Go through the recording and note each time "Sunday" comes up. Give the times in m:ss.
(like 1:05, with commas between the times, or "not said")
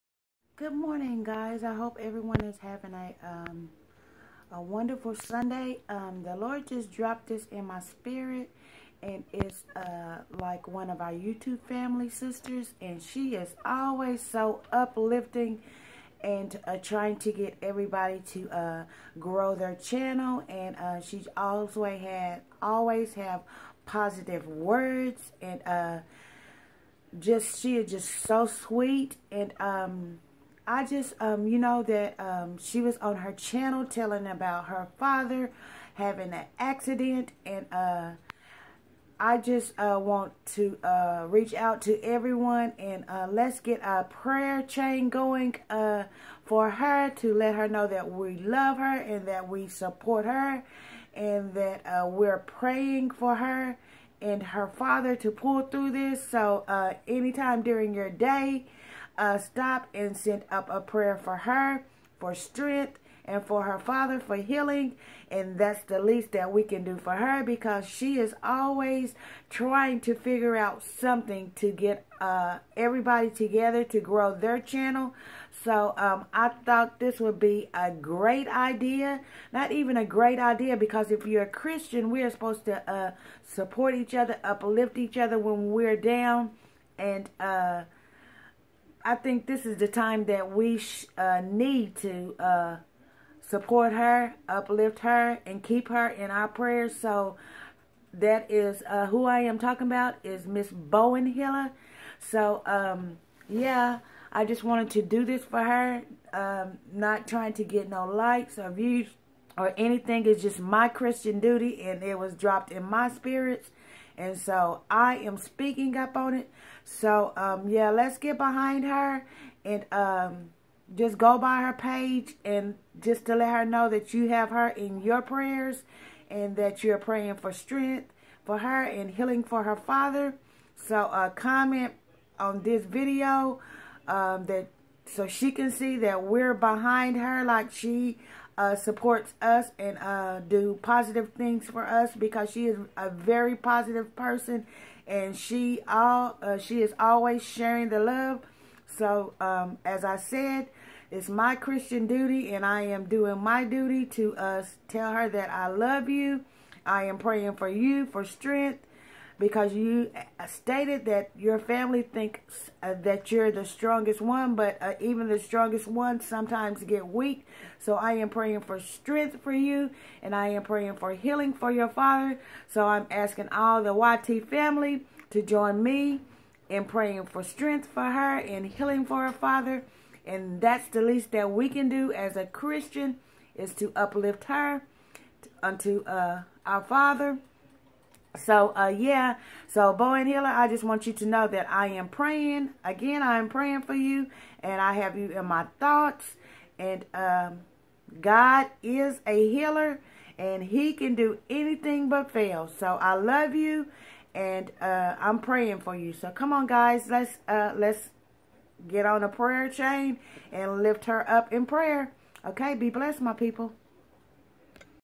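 0:05.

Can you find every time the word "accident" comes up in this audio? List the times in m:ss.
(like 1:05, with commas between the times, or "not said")
0:36.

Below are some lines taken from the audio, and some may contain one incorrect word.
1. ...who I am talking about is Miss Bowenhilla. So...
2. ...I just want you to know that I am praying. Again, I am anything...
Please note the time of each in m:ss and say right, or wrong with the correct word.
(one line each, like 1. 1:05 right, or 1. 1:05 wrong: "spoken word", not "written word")
1. 1:39 right
2. 3:10 wrong: "praying", not "anything".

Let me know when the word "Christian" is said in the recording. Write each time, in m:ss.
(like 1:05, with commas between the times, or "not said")
1:21, 1:50, 2:31, 3:02.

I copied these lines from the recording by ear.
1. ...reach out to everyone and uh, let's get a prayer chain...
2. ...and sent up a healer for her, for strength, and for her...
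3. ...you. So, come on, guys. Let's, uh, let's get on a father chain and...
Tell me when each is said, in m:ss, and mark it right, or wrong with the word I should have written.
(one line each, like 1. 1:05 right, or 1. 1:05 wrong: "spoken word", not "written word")
1. 0:41 right
2. 0:59 wrong: "prayer", not "healer"
3. 3:25 wrong: "prayer", not "father".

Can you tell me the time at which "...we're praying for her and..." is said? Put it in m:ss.
0:52.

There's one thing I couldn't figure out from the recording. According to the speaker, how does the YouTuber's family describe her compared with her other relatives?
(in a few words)
the strongest one.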